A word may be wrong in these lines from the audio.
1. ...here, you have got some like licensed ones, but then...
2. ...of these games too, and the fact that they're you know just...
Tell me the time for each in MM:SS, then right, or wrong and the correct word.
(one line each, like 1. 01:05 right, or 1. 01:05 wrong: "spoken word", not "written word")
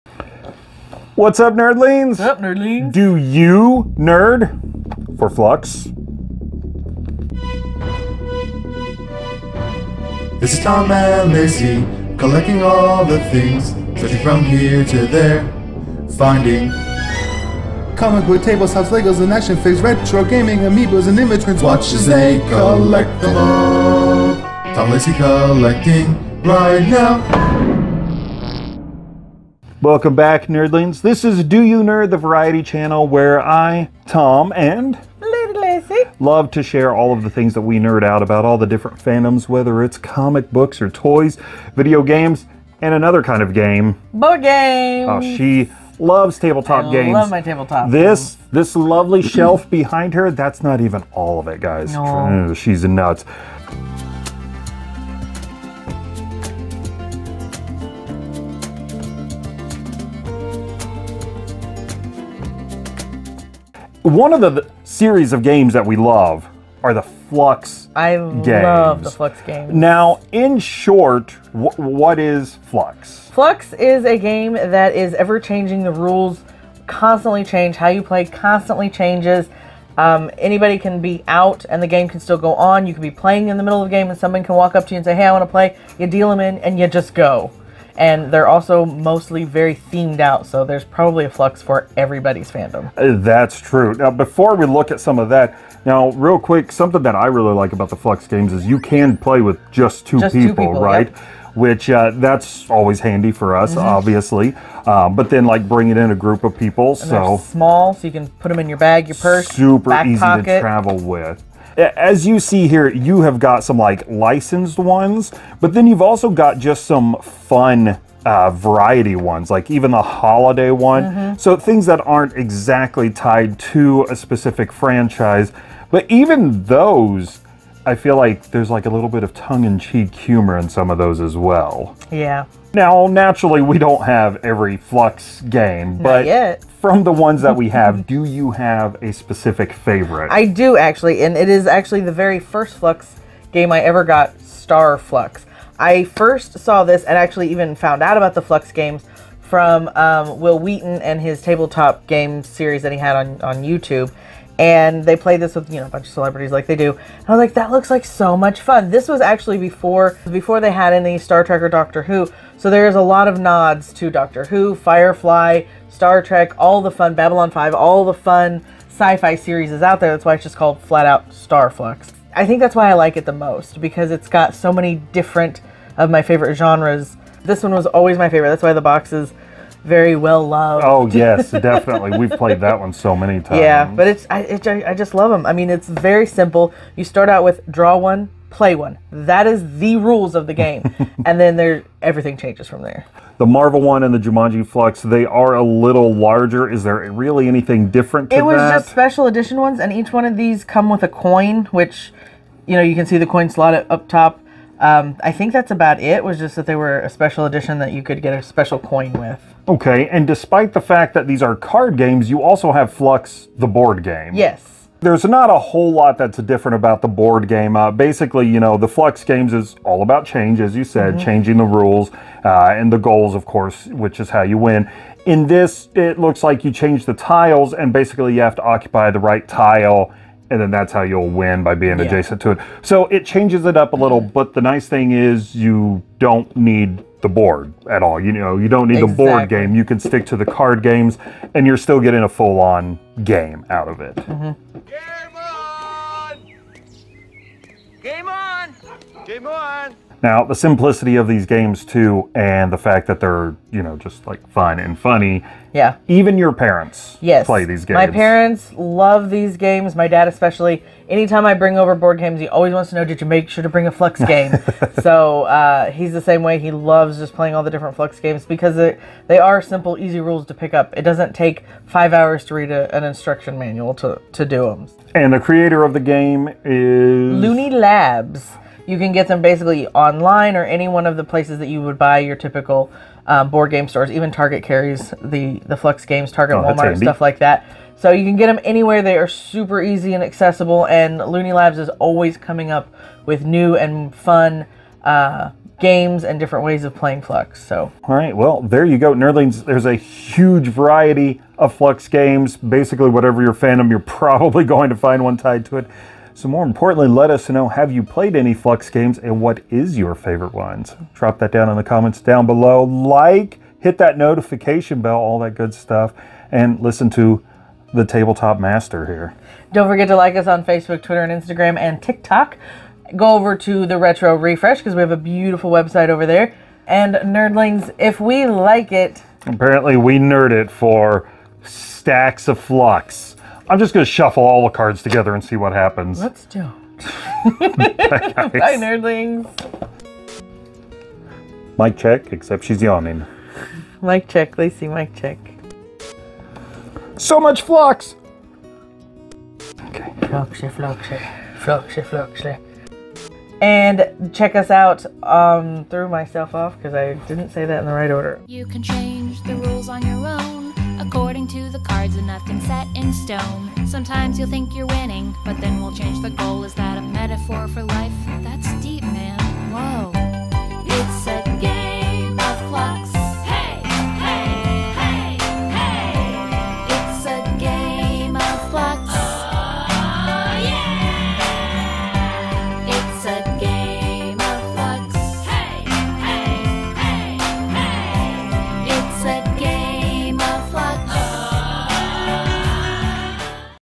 1. 01:52 right
2. 04:11 right.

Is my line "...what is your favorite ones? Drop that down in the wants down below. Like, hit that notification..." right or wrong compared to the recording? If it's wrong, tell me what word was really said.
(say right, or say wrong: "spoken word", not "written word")
wrong: "comments", not "wants".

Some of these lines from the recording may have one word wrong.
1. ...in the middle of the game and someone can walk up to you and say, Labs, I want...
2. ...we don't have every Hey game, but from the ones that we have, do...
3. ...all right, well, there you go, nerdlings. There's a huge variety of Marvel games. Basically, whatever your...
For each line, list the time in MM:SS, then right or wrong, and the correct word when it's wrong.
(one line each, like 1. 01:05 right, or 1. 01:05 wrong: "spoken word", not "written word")
1. 01:23 wrong: "Hey", not "Labs"
2. 02:13 wrong: "Fluxx", not "Hey"
3. 04:58 wrong: "Fluxx", not "Marvel".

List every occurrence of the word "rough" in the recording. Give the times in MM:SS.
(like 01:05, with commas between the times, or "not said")
not said.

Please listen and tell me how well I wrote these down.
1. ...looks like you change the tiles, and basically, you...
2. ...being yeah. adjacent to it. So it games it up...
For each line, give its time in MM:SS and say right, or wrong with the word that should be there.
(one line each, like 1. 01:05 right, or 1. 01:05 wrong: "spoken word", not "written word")
1. 03:46 right
2. 03:51 wrong: "changes", not "games".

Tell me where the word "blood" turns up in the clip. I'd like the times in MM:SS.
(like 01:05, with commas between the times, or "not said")
not said.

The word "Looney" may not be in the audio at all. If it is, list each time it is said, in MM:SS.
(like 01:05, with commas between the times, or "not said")
04:37, 04:51.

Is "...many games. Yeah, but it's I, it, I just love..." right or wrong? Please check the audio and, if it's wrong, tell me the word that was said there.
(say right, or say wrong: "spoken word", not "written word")
wrong: "times", not "games".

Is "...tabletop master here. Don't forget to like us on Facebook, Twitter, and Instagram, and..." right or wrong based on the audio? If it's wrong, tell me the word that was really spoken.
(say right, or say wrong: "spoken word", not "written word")
right.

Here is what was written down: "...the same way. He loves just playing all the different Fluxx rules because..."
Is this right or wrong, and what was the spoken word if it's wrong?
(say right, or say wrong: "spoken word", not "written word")
wrong: "games", not "rules".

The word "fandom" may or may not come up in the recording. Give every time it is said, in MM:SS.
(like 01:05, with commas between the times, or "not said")
00:39, 01:32, 05:03.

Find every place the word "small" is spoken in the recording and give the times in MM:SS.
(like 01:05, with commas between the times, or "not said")
01:47.